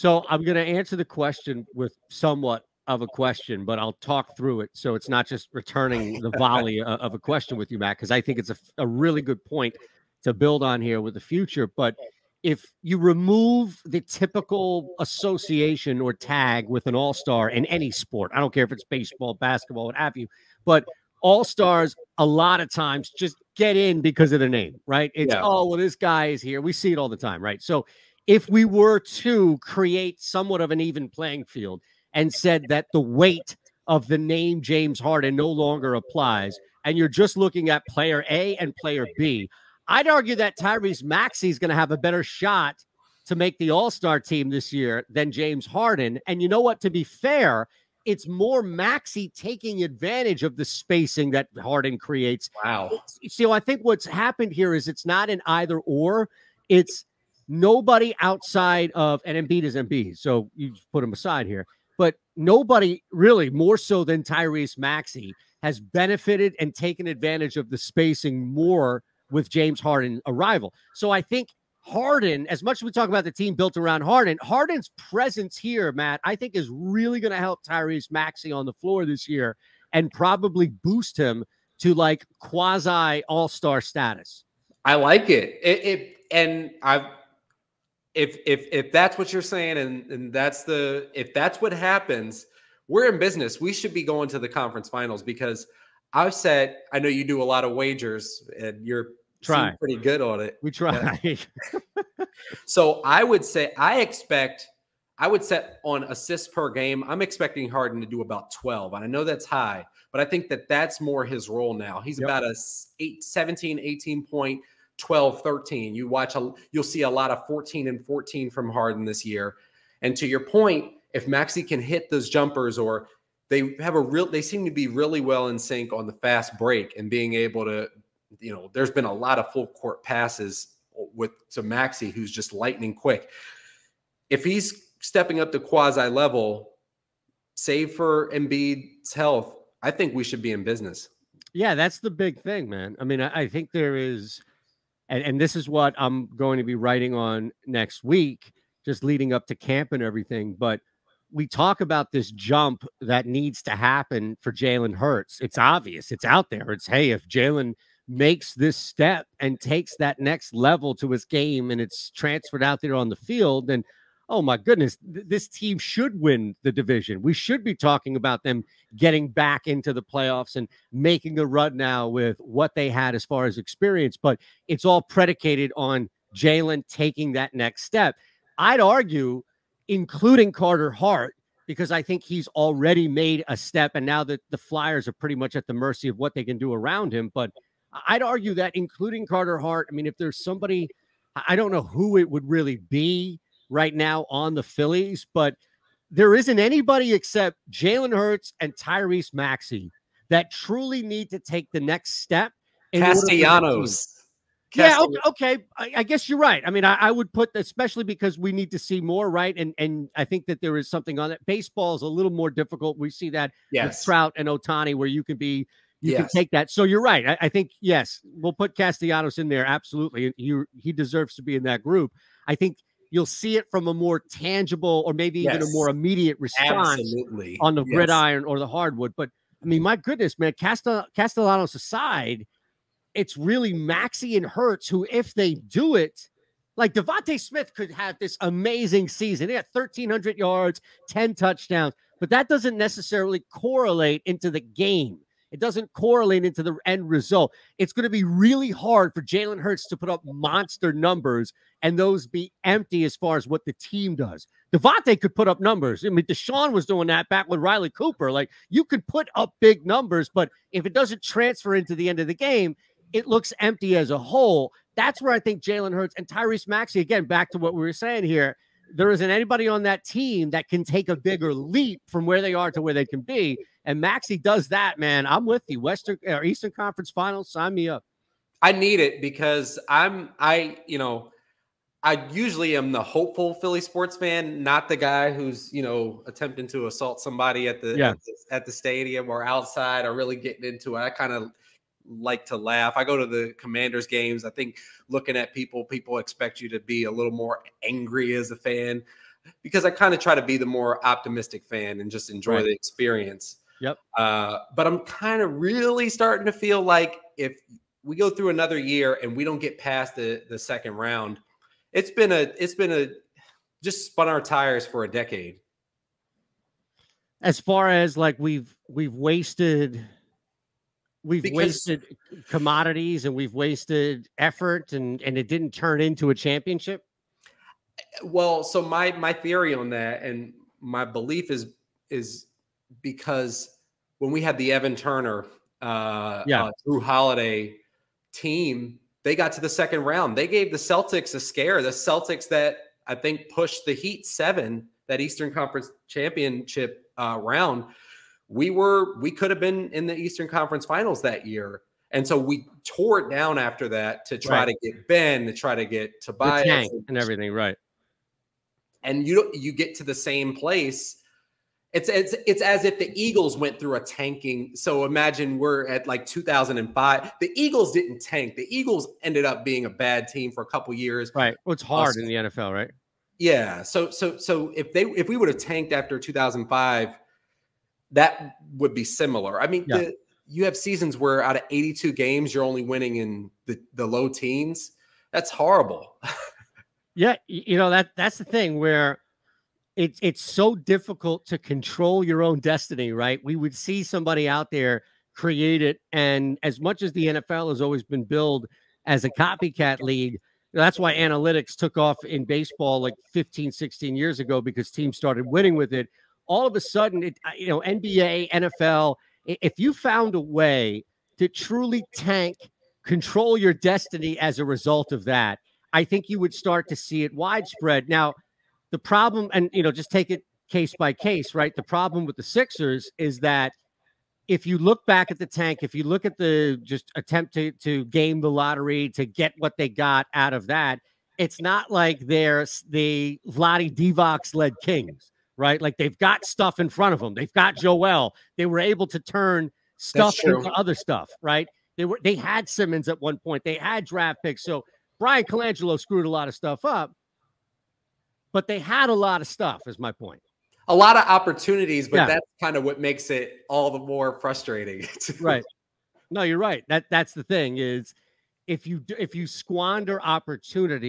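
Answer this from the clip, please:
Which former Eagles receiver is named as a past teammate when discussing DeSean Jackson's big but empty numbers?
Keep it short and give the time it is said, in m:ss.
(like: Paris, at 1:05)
Riley Cooper, at 4:17.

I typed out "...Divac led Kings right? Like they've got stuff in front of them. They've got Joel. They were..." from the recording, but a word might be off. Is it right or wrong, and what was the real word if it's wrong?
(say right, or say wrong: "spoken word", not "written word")
right.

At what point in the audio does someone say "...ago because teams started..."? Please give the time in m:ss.
6:44.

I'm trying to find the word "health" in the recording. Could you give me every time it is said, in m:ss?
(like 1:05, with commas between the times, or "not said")
2:19.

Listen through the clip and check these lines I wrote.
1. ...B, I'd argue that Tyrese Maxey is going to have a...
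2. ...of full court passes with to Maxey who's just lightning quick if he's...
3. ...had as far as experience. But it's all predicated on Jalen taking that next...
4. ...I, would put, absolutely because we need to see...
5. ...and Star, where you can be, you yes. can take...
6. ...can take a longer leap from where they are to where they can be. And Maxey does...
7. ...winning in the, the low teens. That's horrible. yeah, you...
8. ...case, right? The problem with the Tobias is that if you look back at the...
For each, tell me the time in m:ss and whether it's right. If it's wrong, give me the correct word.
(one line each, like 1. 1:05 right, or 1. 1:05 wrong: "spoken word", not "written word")
1. 0:39 right
2. 2:09 right
3. 2:52 right
4. 3:26 wrong: "especially", not "absolutely"
5. 3:34 wrong: "Ohtani", not "Star"
6. 4:30 wrong: "bigger", not "longer"
7. 6:22 right
8. 7:01 wrong: "Sixers", not "Tobias".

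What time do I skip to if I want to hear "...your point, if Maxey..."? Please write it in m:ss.
2:00.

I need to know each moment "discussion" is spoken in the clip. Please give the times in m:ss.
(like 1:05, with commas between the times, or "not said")
not said.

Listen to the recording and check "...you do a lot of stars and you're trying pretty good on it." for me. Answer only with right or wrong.
wrong.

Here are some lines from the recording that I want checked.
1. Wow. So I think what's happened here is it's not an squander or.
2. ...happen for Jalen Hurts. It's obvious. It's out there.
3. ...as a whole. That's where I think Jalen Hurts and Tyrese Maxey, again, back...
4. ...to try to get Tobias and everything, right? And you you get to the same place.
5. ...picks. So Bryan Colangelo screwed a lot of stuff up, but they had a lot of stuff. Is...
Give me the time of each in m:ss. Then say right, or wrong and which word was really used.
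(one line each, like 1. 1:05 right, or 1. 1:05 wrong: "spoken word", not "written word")
1. 0:52 wrong: "either", not "squander"
2. 2:33 right
3. 4:23 right
4. 5:55 right
5. 7:24 right.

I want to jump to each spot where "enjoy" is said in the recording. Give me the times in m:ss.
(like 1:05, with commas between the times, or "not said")
5:02.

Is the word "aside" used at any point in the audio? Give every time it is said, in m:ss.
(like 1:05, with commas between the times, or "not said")
1:01, 3:51.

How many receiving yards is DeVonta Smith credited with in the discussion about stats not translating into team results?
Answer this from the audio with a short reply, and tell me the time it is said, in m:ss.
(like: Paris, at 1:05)
1,300, at 3:59.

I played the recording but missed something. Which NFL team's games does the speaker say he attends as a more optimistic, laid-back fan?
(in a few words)
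Commanders.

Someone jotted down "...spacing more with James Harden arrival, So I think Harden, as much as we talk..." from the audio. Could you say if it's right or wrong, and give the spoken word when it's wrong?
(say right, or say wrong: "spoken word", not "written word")
right.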